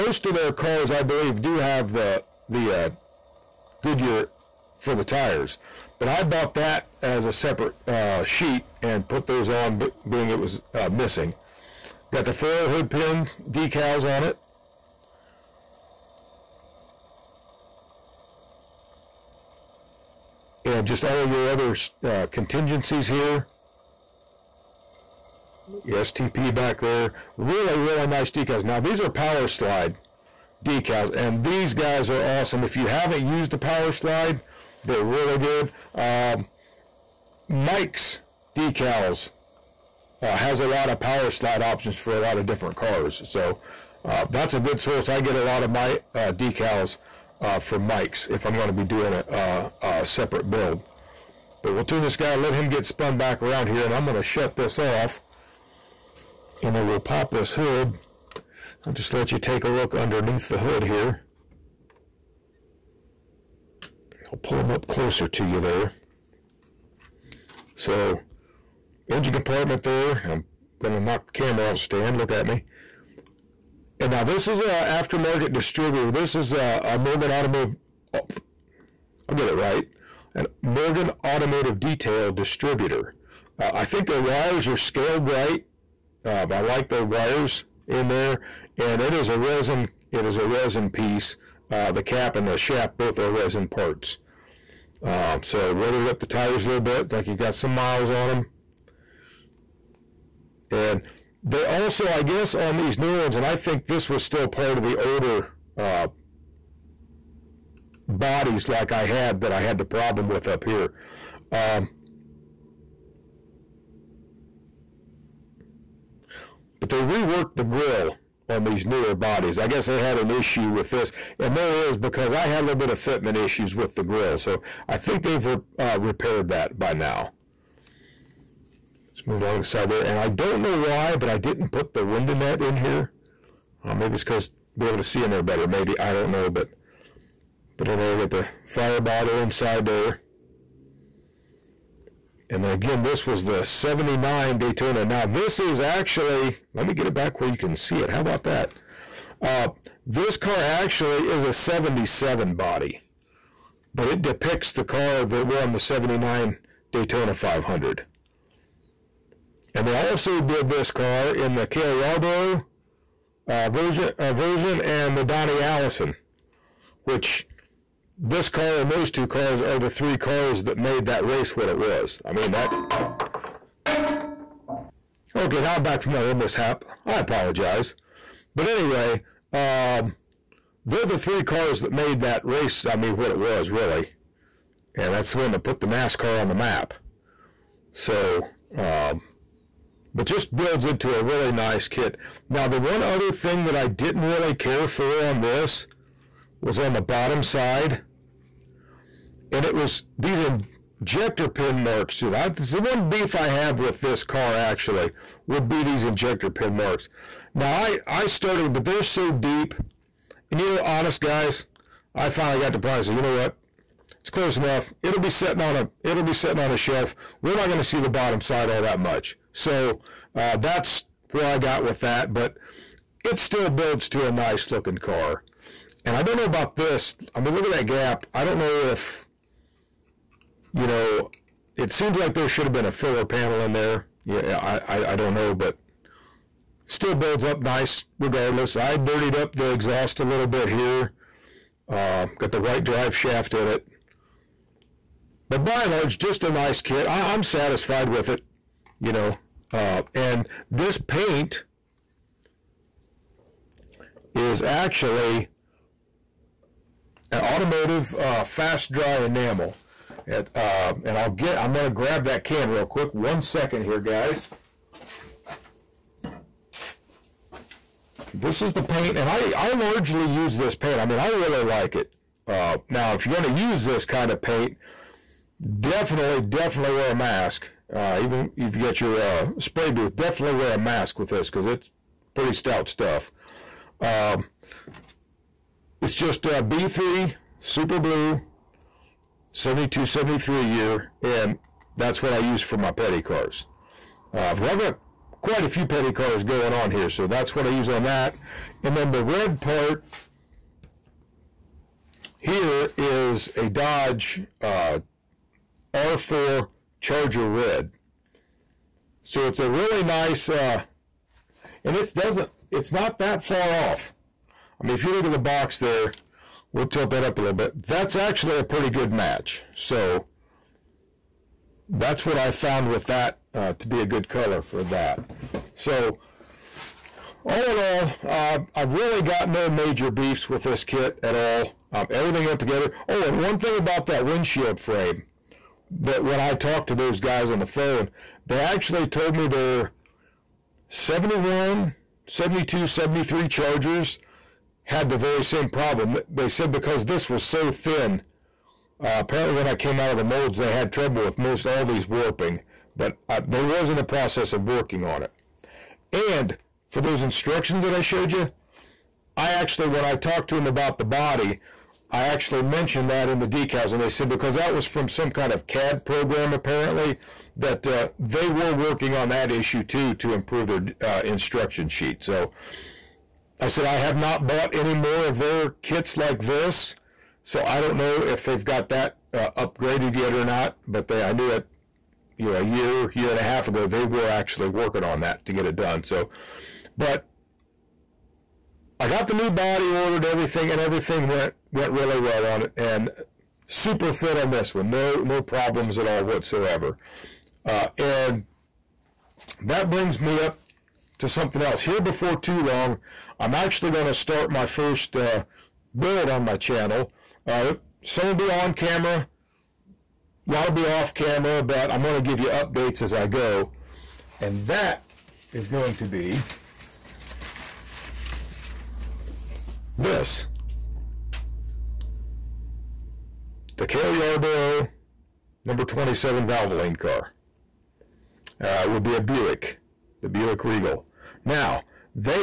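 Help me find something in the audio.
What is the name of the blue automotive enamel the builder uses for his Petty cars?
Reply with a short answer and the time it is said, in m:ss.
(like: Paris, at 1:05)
B3 Super Blue, at 4:46.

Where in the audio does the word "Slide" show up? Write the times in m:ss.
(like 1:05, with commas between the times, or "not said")
0:29, 0:33, 0:41.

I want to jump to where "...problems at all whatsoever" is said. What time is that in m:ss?
6:35.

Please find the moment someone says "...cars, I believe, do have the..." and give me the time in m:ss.
0:00.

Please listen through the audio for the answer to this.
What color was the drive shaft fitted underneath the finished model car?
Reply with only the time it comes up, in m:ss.
4:02.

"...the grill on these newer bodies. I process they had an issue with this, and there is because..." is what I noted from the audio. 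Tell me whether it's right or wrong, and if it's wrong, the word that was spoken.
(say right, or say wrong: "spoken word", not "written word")
wrong: "guess", not "process".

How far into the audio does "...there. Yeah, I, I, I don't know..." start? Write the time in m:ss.
3:53.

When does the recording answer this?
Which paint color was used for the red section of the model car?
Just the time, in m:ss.
5:05.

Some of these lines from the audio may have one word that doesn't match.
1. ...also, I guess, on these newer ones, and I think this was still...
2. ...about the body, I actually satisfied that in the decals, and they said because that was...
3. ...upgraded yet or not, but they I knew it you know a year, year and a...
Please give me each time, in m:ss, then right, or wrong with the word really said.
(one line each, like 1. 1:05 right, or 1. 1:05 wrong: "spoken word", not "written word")
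1. 1:41 right
2. 6:00 wrong: "mentioned", not "satisfied"
3. 6:19 right.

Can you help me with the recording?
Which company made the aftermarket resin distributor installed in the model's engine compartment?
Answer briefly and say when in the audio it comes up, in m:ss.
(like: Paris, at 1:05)
Morgan Automotive Detail, at 1:20.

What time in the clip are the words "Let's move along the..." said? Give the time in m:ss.
2:09.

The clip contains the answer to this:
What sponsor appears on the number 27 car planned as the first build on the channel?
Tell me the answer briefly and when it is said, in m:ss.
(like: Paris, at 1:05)
Valvoline, at 7:06.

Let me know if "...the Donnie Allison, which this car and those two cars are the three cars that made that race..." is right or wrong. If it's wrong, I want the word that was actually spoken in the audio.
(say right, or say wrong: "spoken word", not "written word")
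right.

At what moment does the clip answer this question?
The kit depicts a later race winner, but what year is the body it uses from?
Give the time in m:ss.
2:31.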